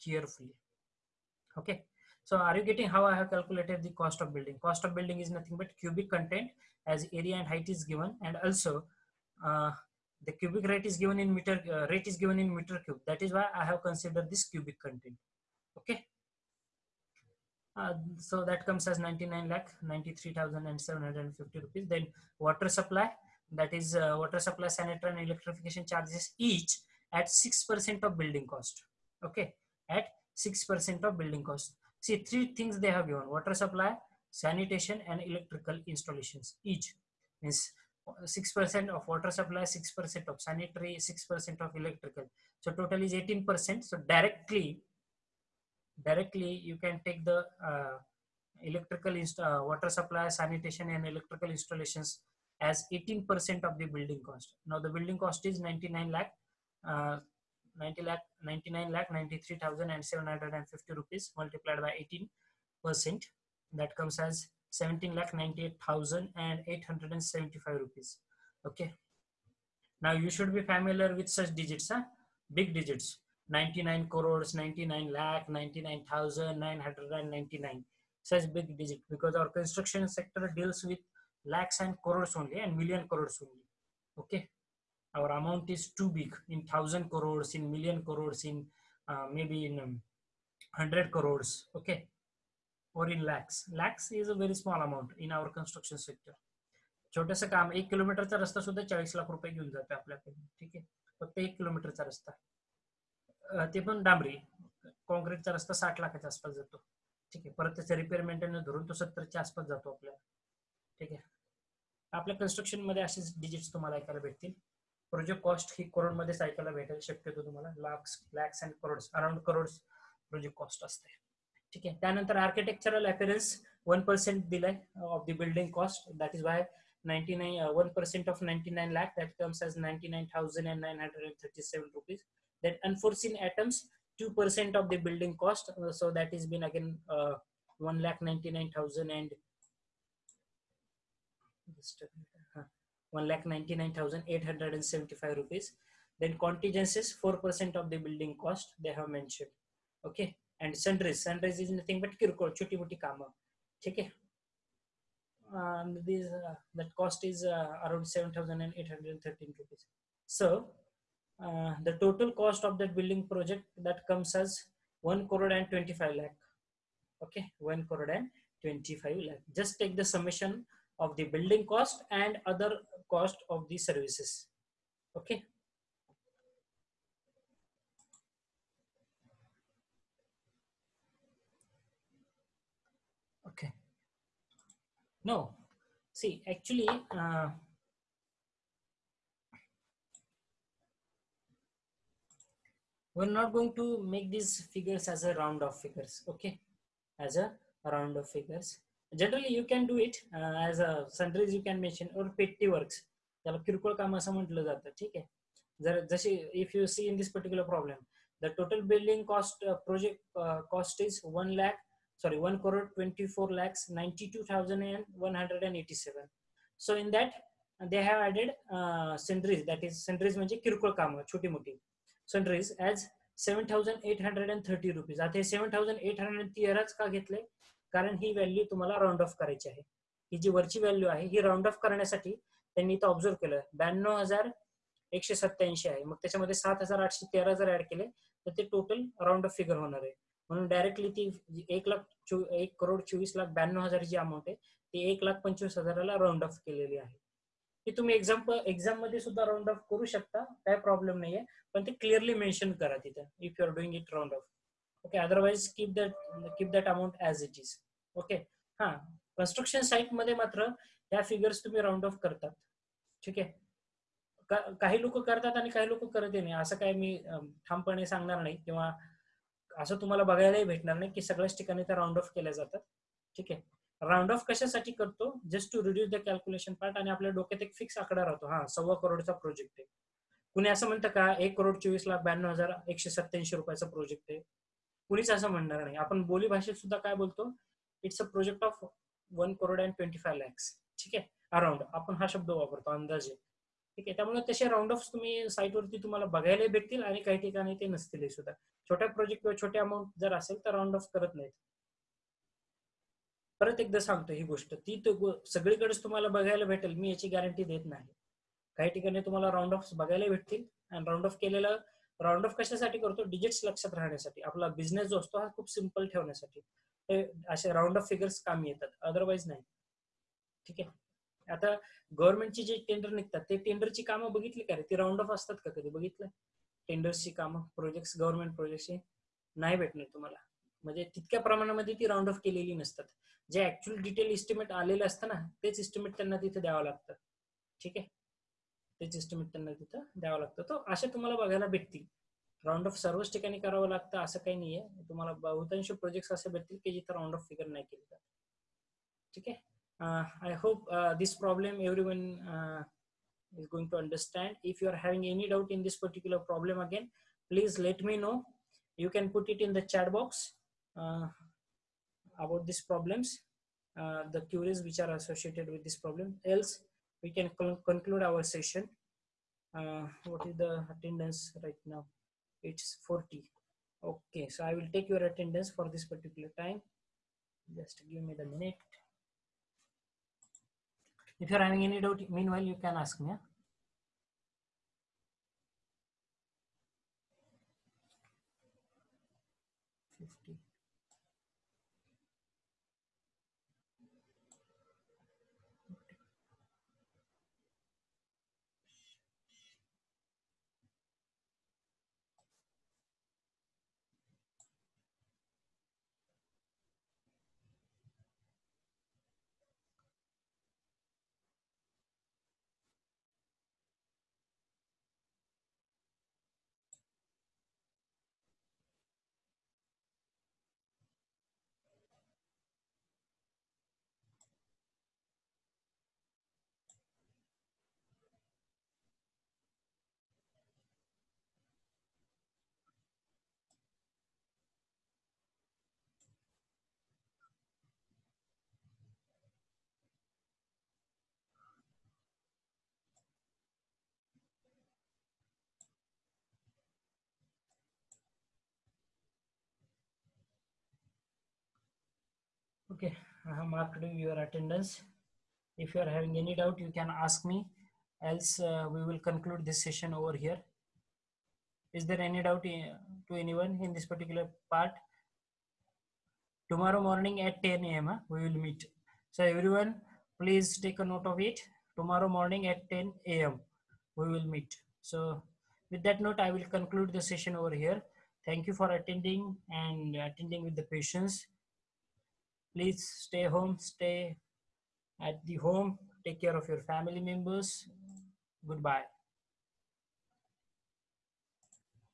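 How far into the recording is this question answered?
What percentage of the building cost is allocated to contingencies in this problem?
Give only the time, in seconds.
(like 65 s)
147 s.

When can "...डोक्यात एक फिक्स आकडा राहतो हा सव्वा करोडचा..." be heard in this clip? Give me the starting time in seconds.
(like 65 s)
277 s.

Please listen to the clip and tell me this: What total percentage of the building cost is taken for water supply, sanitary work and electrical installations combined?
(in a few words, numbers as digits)
18%.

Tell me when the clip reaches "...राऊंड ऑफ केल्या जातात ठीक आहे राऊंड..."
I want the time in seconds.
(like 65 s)
271 s.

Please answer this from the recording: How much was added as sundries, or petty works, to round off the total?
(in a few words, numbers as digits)
7,813 rupees.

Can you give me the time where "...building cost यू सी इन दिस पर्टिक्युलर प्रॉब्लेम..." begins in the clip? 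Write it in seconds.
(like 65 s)
208 s.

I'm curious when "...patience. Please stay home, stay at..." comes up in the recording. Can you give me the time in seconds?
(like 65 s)
480 s.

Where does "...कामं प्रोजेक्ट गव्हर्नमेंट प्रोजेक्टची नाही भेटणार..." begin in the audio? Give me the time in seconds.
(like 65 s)
327 s.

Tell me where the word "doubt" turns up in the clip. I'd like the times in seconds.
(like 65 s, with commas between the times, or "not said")
382 s, 456 s, 462 s.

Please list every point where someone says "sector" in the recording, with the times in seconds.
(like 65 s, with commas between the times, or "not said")
80 s, 95 s.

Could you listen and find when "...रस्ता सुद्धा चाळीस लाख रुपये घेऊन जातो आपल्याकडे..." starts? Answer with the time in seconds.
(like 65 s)
98 s.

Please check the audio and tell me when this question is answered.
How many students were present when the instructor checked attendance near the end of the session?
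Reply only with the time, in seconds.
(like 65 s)
372 s.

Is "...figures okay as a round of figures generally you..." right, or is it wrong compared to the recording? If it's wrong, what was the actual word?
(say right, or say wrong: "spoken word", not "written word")
right.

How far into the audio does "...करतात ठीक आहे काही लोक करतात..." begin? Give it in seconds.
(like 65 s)
262 s.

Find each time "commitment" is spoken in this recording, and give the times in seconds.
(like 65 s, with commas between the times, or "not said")
not said.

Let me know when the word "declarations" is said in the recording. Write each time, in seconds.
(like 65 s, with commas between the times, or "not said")
not said.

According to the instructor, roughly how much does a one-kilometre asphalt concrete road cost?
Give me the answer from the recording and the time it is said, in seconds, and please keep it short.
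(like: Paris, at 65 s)
60 lakh, at 105 s.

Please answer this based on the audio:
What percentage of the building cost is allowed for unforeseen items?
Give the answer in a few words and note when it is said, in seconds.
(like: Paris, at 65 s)
2%, at 134 s.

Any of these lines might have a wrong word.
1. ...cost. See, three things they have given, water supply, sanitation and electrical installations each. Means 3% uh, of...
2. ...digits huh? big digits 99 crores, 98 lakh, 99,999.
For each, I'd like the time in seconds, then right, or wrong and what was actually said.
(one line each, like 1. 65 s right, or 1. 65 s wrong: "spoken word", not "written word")
1. 31 s wrong: "6", not "3"
2. 71 s wrong: "99", not "98".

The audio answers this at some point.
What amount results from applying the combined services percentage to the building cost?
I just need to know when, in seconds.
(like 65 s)
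64 s.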